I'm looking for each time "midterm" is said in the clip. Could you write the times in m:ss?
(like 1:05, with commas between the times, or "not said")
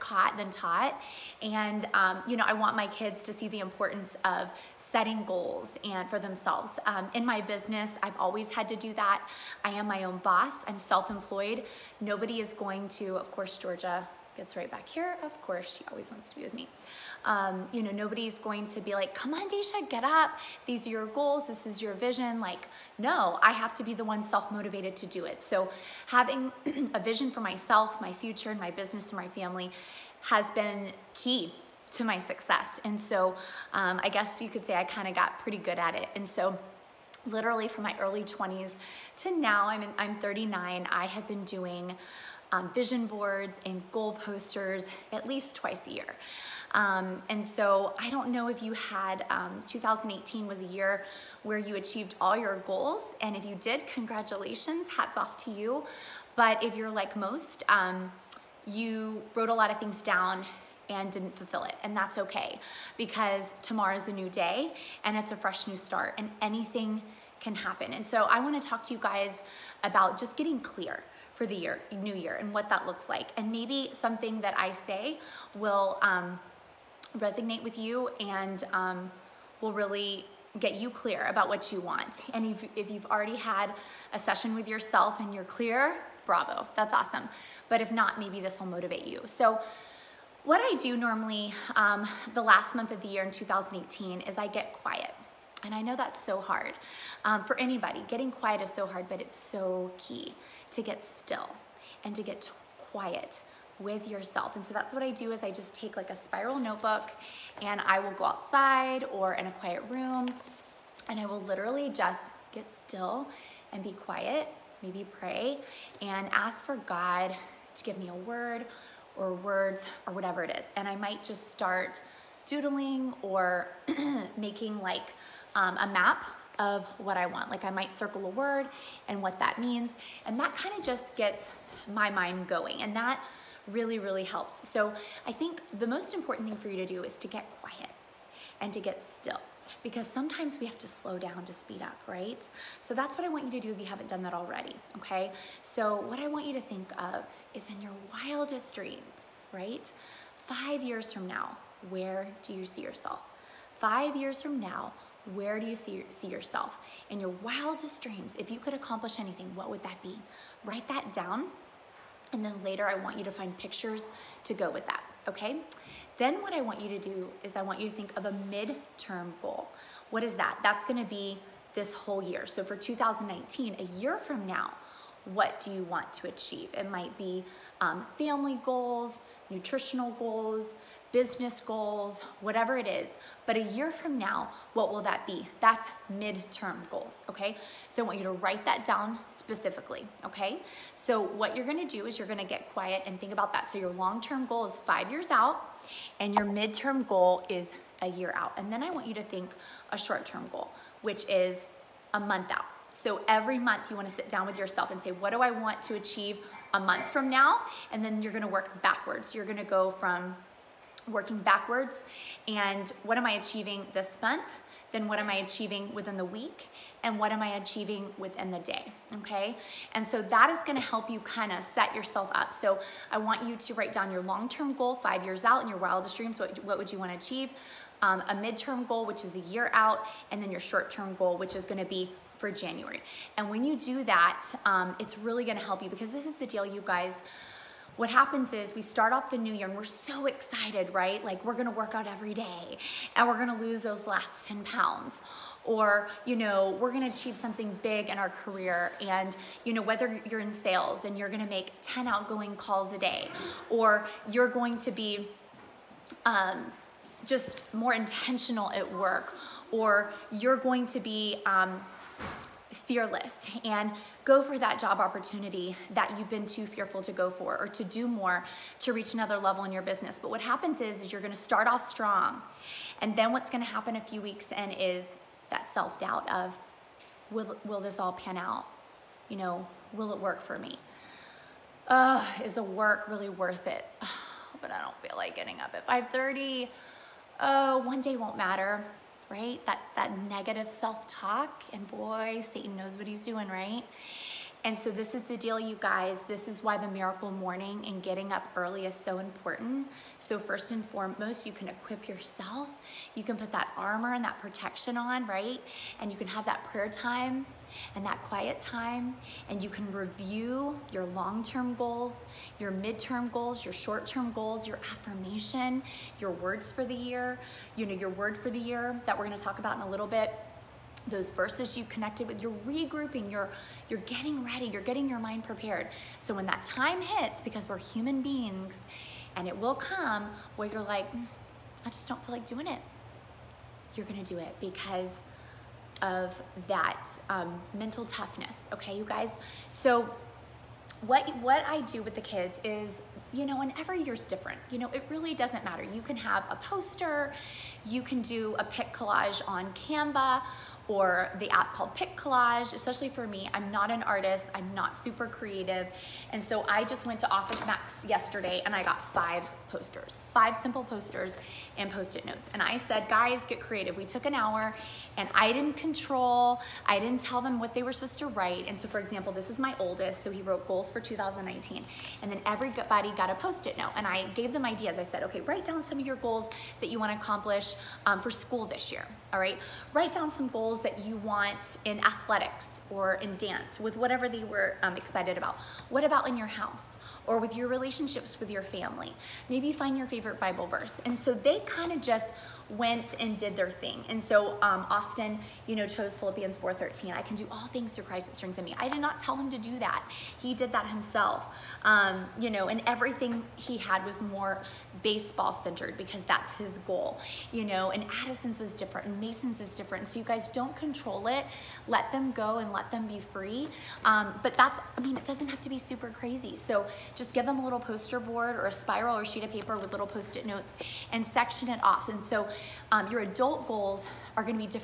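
2:48, 3:06, 3:16, 3:48, 5:12.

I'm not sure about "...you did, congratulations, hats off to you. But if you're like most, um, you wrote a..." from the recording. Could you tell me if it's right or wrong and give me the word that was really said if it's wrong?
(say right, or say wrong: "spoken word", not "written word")
right.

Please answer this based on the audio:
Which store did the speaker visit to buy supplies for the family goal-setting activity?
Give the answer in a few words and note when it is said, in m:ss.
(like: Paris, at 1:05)
Office Max, at 5:57.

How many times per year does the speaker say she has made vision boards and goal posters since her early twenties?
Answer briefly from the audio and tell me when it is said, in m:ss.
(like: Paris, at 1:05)
twice, at 0:45.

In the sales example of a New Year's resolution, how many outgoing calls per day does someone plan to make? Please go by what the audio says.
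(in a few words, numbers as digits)
10.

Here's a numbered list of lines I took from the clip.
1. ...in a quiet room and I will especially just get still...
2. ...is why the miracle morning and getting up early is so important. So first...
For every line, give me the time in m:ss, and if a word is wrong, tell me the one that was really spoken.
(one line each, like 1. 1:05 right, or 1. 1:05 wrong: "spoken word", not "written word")
1. 1:49 wrong: "literally", not "especially"
2. 4:56 right.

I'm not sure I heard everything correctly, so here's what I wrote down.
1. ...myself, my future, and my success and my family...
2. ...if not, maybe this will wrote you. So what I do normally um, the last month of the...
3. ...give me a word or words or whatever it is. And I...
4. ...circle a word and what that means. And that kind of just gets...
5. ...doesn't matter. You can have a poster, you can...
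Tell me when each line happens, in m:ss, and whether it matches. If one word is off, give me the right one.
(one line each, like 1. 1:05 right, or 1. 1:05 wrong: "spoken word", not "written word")
1. 0:27 wrong: "business", not "success"
2. 1:27 wrong: "motivate", not "wrote"
3. 1:57 right
4. 2:07 right
5. 5:45 right.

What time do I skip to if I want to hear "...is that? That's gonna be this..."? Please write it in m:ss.
2:50.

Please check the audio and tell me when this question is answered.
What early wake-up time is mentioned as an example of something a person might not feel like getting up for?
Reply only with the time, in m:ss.
4:45.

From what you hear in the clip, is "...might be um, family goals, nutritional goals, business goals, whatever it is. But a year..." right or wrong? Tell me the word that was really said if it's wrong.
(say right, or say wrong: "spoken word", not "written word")
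right.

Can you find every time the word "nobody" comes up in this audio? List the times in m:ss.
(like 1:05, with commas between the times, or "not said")
0:11, 0:17.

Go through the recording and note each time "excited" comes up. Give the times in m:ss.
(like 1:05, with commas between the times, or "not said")
4:00, 6:24.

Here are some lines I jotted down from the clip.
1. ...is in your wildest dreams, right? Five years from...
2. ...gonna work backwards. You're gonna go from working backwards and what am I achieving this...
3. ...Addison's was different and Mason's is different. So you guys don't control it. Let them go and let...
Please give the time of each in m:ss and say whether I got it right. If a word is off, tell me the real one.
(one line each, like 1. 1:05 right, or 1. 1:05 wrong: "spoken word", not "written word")
1. 2:27 right
2. 3:28 right
3. 6:48 right.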